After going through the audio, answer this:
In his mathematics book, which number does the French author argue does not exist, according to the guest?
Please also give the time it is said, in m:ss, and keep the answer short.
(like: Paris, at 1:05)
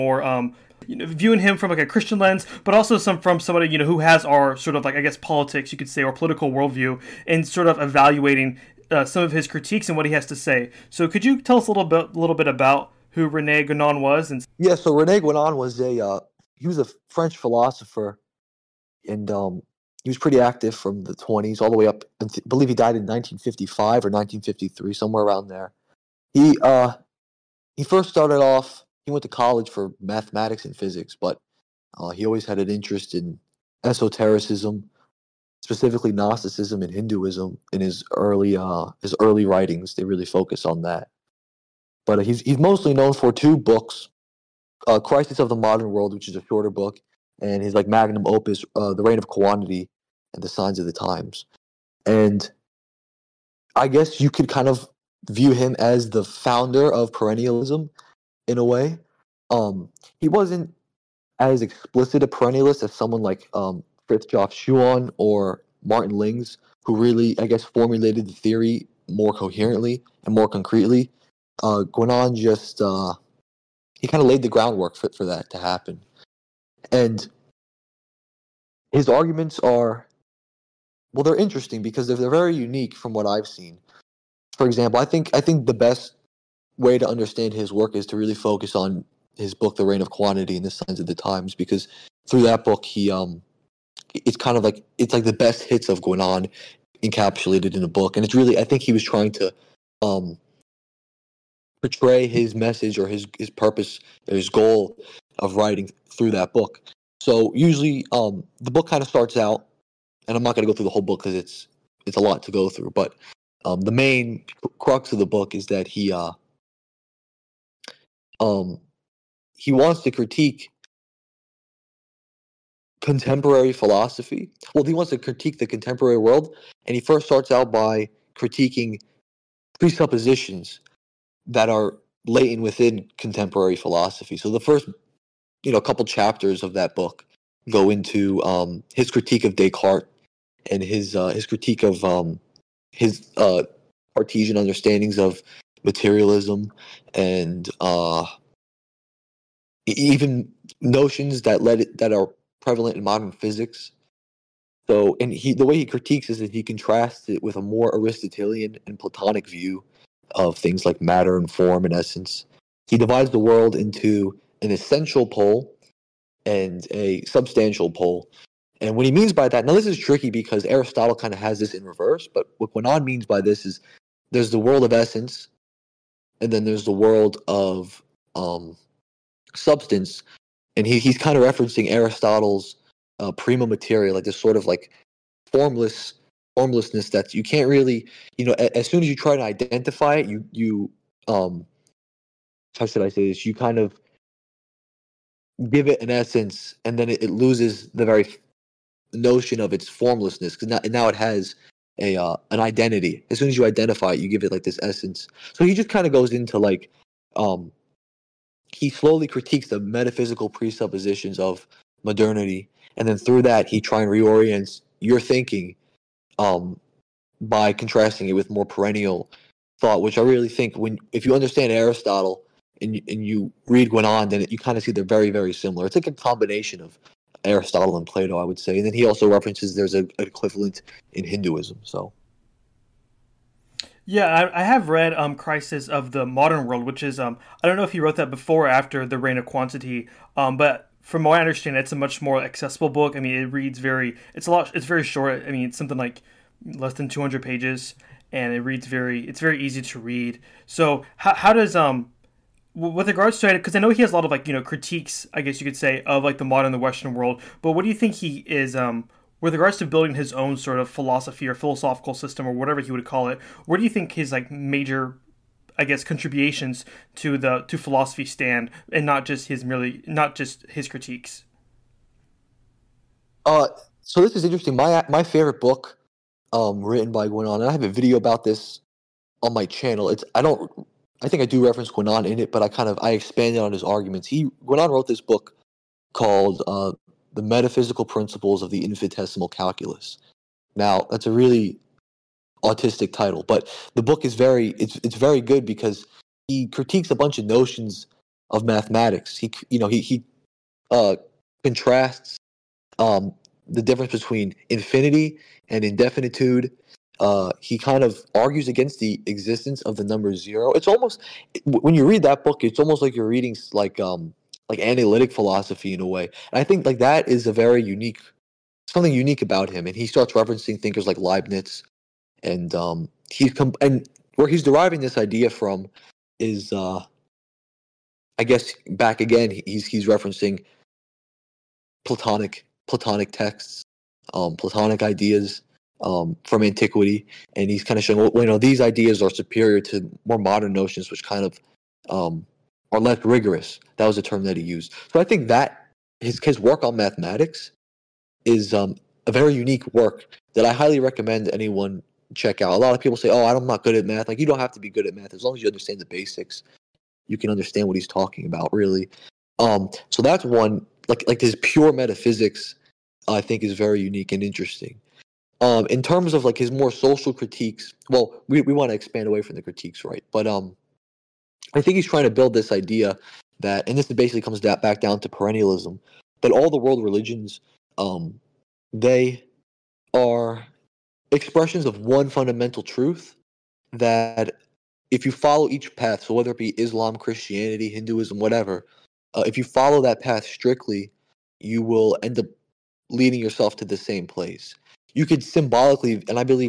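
Zero, at 5:10.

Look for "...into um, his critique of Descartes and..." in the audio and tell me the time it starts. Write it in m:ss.
2:17.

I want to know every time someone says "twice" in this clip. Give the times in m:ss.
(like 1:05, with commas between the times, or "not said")
not said.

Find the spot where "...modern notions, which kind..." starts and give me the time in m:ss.
5:40.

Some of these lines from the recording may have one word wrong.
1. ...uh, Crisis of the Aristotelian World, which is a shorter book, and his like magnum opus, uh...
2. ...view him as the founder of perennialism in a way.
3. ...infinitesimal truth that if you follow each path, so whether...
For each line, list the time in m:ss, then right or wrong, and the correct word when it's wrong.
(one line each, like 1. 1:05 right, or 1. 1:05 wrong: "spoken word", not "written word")
1. 0:44 wrong: "Modern", not "Aristotelian"
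2. 0:55 right
3. 6:22 wrong: "fundamental", not "infinitesimal".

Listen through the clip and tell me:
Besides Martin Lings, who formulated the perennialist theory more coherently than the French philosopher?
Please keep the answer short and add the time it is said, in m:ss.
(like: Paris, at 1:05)
Fritjof Schuon, at 1:04.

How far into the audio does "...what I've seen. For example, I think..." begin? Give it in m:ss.
1:23.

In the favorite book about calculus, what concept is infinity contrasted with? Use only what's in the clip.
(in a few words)
Indefinitude.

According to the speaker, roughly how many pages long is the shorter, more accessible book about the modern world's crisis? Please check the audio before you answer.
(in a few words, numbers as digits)
Less than 200.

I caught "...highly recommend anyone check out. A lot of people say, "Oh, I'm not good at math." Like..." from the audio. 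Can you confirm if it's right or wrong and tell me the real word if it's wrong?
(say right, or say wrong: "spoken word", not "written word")
right.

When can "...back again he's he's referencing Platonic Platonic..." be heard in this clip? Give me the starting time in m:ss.
5:28.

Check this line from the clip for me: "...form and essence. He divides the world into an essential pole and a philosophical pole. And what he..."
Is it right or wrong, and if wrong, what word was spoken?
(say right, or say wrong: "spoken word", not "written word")
wrong: "substantial", not "philosophical".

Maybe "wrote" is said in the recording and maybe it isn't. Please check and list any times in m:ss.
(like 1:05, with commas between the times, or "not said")
3:57, 4:44.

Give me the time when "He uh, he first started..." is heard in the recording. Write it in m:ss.
0:26.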